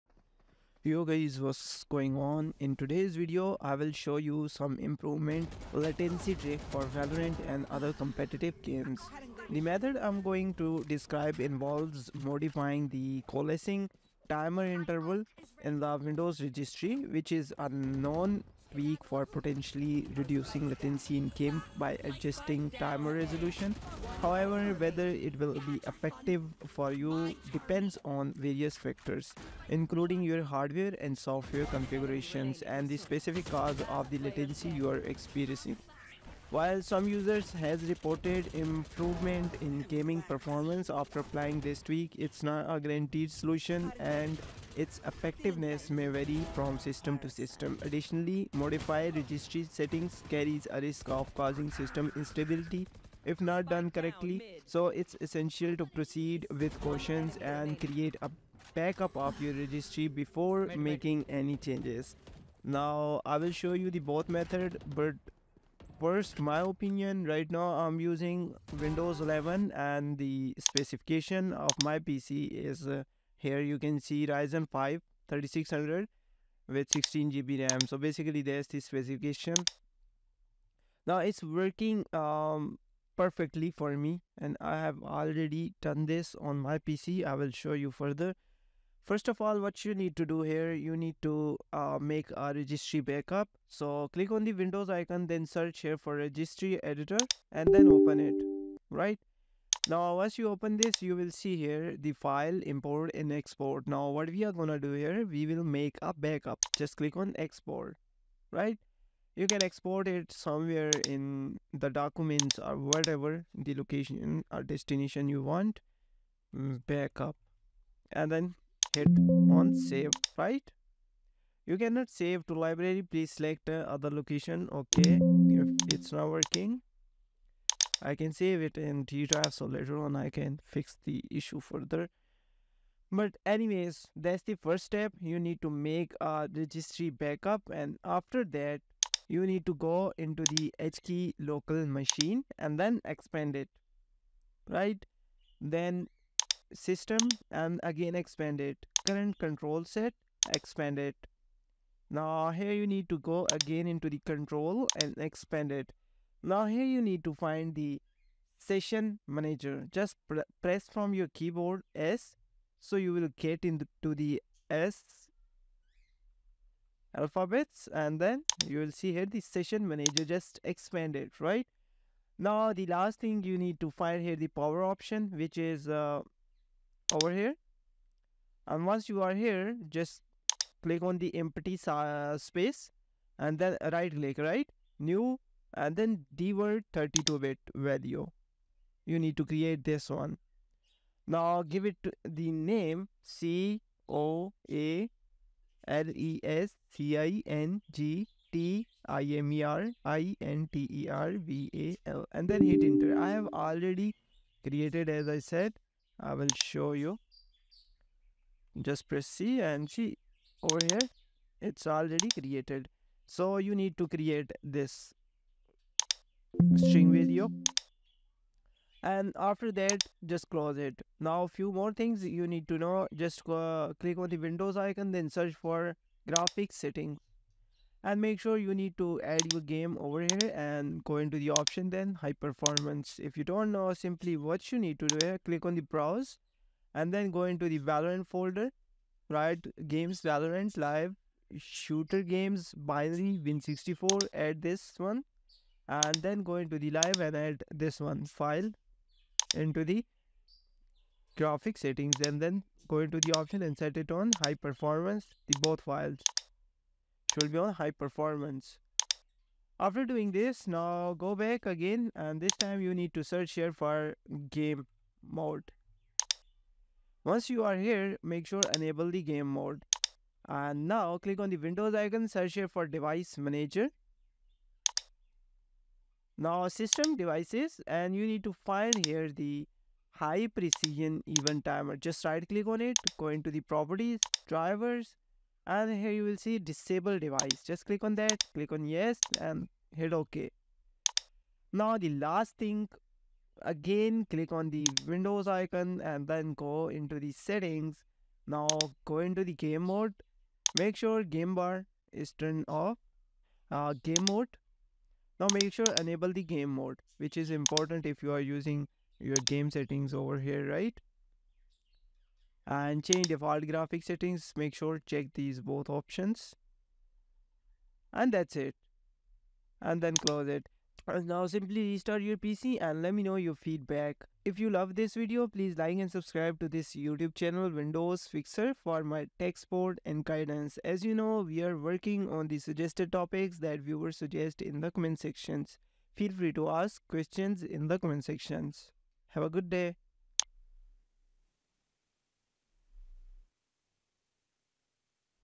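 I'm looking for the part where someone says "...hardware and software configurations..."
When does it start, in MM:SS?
00:30.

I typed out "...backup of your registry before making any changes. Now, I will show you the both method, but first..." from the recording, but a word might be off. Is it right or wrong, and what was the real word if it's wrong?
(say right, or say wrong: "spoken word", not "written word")
right.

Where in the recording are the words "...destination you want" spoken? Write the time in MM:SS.
01:54.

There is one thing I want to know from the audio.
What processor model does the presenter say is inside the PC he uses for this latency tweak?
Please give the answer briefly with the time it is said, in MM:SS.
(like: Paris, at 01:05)
Ryzen 5 3600, at 01:14.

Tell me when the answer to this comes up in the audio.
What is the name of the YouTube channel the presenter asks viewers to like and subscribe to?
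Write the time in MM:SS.
05:27.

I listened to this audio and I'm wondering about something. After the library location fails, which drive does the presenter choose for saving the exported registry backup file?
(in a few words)
G drive.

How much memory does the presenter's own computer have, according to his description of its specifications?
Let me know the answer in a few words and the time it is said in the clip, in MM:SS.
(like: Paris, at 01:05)
16 GB, at 01:16.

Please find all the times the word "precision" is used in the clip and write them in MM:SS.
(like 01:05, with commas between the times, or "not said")
04:40.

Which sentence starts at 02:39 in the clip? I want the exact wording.
Just pr press from your keyboard S.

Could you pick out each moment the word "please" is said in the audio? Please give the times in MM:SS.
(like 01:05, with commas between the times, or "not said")
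02:03, 05:25.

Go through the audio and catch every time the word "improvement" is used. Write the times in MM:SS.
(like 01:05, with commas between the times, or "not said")
00:04, 00:38.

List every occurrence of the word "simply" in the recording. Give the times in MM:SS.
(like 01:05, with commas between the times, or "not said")
03:53, 05:21.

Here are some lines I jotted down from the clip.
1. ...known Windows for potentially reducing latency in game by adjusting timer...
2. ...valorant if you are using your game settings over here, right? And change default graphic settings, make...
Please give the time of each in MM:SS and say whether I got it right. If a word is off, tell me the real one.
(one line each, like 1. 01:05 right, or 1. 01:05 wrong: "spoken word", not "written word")
1. 00:17 wrong: "Week", not "Windows"
2. 05:07 wrong: "important", not "valorant".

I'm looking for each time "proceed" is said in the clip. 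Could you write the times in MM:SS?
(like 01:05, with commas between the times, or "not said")
00:55.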